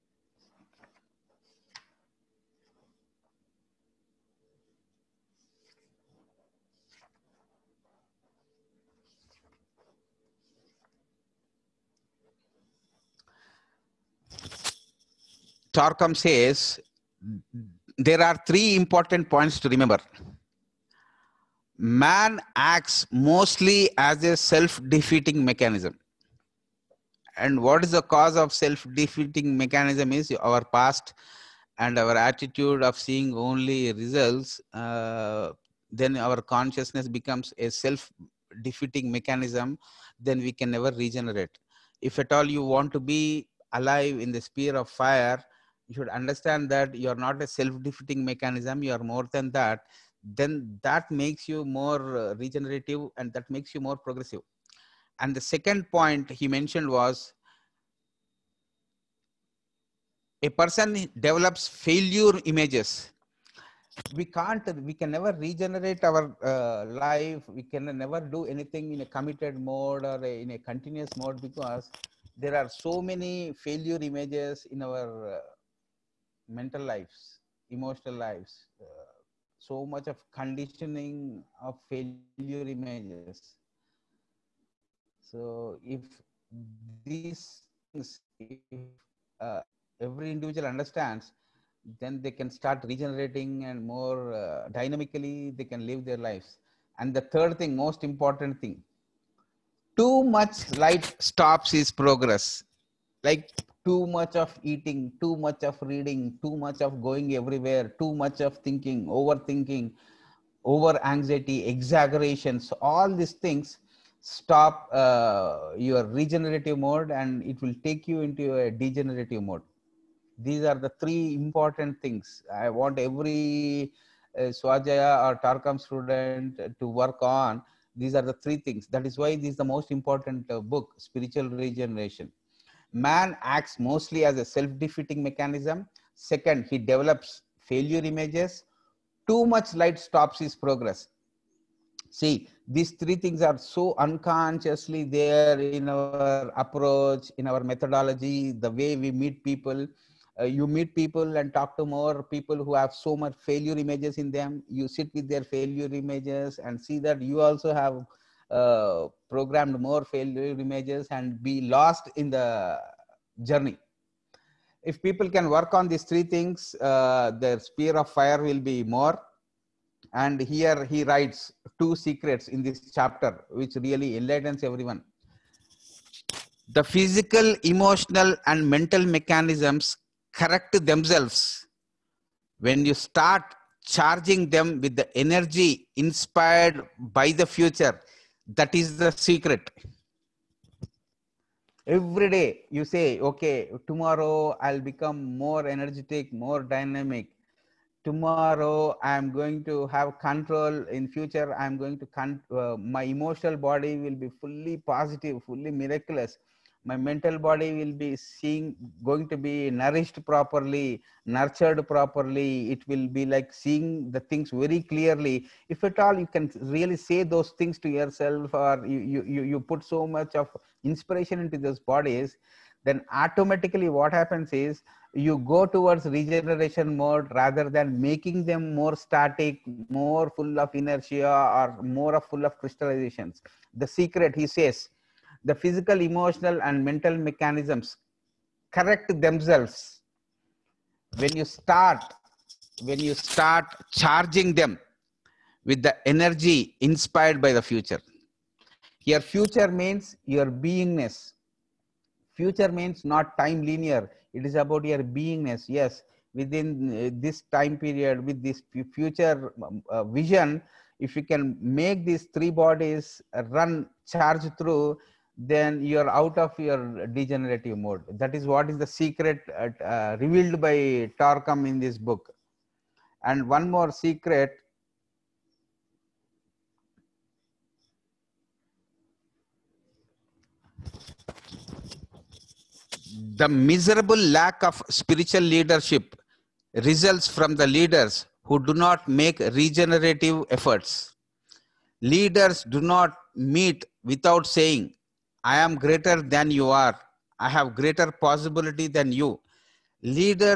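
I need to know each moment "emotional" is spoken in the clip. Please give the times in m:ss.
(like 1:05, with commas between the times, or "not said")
1:17, 2:57, 3:23, 3:56.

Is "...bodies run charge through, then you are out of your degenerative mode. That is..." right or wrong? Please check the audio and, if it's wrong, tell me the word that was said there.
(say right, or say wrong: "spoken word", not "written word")
right.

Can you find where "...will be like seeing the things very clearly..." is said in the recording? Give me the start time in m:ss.
3:32.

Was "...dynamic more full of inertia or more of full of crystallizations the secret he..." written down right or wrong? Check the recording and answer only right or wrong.
wrong.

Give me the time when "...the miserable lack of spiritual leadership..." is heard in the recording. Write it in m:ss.
4:43.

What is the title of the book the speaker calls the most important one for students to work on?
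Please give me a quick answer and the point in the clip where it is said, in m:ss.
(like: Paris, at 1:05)
Spiritual Regeneration, at 2:11.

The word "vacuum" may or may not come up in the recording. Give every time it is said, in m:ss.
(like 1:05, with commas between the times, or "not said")
not said.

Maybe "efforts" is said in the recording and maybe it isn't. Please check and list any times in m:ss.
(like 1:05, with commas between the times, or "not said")
4:50.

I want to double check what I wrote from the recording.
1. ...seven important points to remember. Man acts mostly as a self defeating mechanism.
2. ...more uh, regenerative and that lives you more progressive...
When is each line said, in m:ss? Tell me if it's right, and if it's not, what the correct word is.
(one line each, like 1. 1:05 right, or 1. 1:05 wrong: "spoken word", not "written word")
1. 0:18 wrong: "three", not "seven"
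2. 0:51 wrong: "makes", not "lives".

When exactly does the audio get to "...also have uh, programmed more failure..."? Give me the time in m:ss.
2:37.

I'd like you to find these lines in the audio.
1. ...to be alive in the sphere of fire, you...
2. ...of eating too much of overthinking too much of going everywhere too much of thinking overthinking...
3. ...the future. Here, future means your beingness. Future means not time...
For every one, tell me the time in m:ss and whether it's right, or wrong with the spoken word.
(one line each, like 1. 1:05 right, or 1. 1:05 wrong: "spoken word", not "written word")
1. 0:42 right
2. 1:44 wrong: "reading", not "overthinking"
3. 4:07 right.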